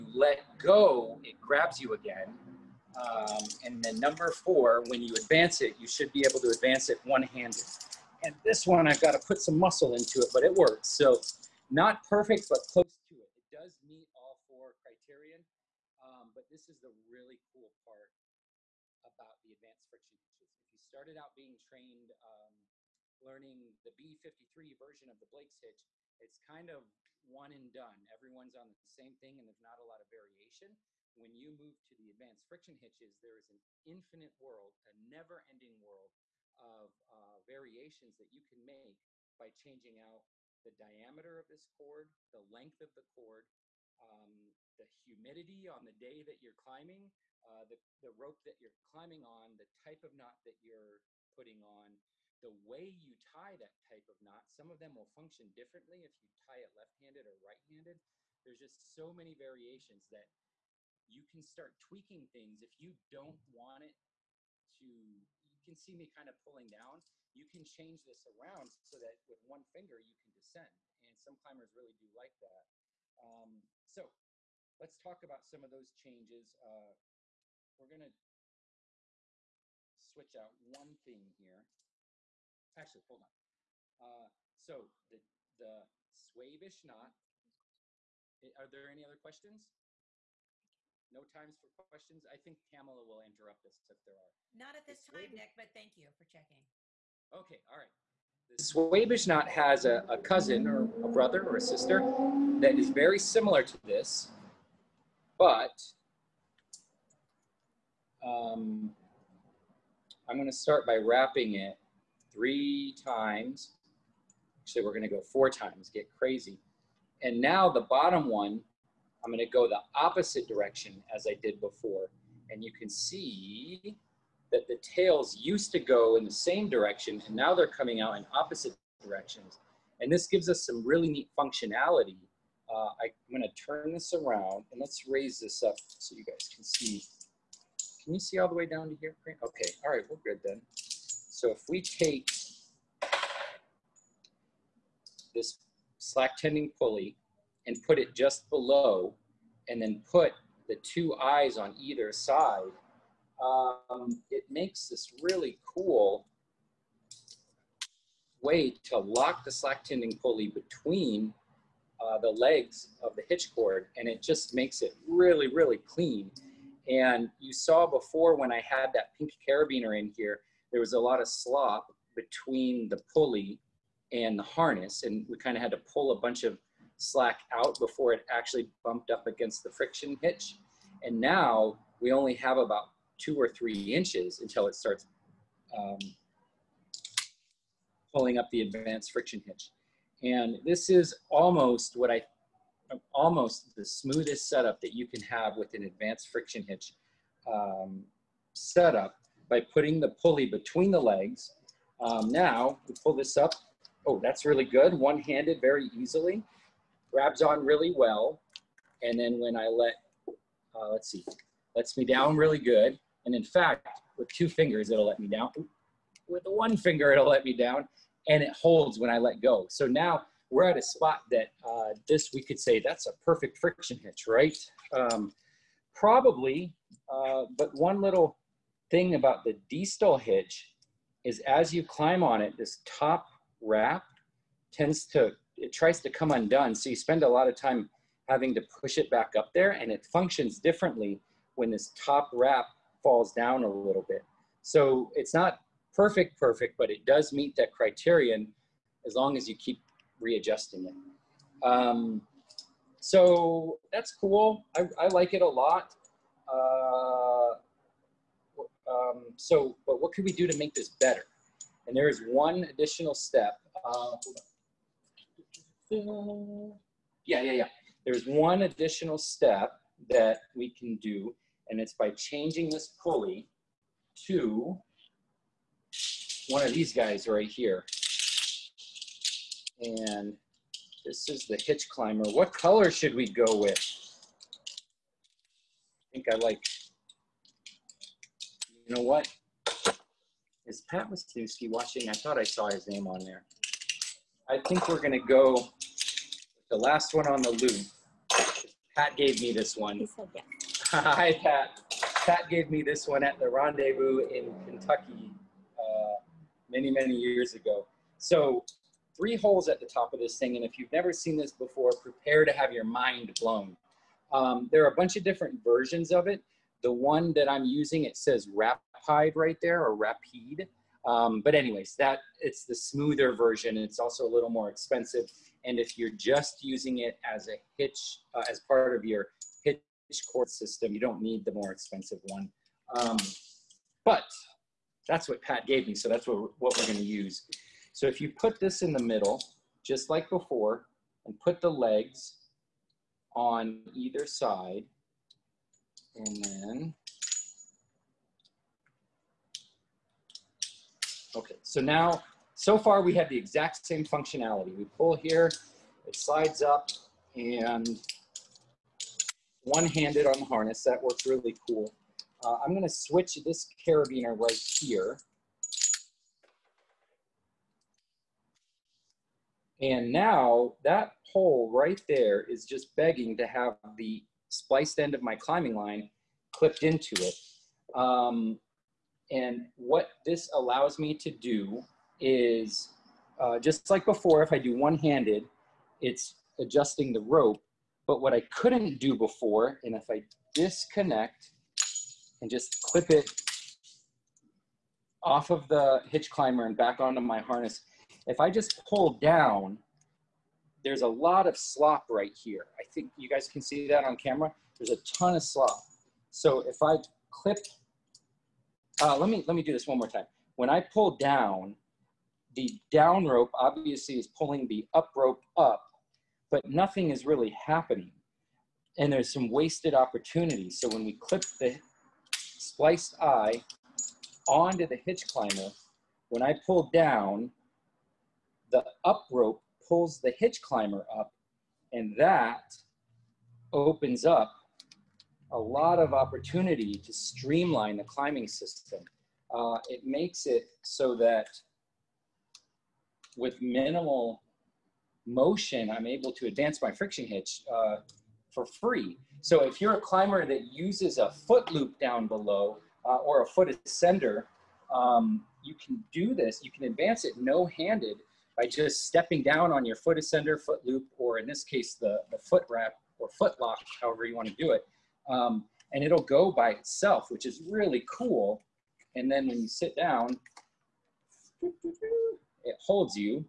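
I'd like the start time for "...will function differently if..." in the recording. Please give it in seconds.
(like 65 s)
54 s.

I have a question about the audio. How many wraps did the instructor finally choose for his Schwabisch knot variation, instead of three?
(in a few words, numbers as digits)
4.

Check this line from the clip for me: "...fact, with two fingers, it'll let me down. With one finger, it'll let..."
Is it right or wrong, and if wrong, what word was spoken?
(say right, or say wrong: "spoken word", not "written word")
right.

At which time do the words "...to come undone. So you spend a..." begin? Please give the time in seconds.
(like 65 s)
236 s.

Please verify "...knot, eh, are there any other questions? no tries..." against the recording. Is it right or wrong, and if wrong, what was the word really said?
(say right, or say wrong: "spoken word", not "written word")
wrong: "times", not "tries".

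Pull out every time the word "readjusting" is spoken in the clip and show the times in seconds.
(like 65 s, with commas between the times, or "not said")
250 s.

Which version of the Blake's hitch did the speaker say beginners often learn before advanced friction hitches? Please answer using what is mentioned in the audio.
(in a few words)
B53.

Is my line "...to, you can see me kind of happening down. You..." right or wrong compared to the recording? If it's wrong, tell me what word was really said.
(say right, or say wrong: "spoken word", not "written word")
wrong: "pulling", not "happening".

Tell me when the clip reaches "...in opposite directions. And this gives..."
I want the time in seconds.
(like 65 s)
128 s.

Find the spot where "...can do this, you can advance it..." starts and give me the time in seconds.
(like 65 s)
455 s.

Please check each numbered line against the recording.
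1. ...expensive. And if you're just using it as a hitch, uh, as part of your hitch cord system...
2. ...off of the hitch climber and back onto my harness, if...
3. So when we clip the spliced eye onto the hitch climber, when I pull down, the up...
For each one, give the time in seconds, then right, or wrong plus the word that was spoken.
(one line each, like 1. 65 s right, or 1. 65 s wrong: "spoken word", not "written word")
1. 324 s right
2. 395 s right
3. 420 s right.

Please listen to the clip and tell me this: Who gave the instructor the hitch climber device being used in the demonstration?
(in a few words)
Pat Wisniewski.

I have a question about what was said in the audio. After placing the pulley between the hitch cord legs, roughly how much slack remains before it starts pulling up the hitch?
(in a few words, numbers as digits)
2 or 3 inches.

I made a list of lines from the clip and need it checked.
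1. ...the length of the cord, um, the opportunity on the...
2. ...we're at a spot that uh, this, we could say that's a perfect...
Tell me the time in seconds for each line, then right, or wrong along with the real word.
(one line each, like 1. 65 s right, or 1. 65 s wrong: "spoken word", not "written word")
1. 42 s wrong: "humidity", not "opportunity"
2. 220 s right.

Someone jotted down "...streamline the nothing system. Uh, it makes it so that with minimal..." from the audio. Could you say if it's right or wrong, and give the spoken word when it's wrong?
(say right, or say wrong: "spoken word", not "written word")
wrong: "climbing", not "nothing".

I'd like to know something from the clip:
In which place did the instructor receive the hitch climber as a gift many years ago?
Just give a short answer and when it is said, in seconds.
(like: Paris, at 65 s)
Kentucky, at 304 s.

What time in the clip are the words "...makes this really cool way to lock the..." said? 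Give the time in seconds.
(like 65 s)
154 s.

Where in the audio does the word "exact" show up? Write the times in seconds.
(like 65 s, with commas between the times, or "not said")
353 s.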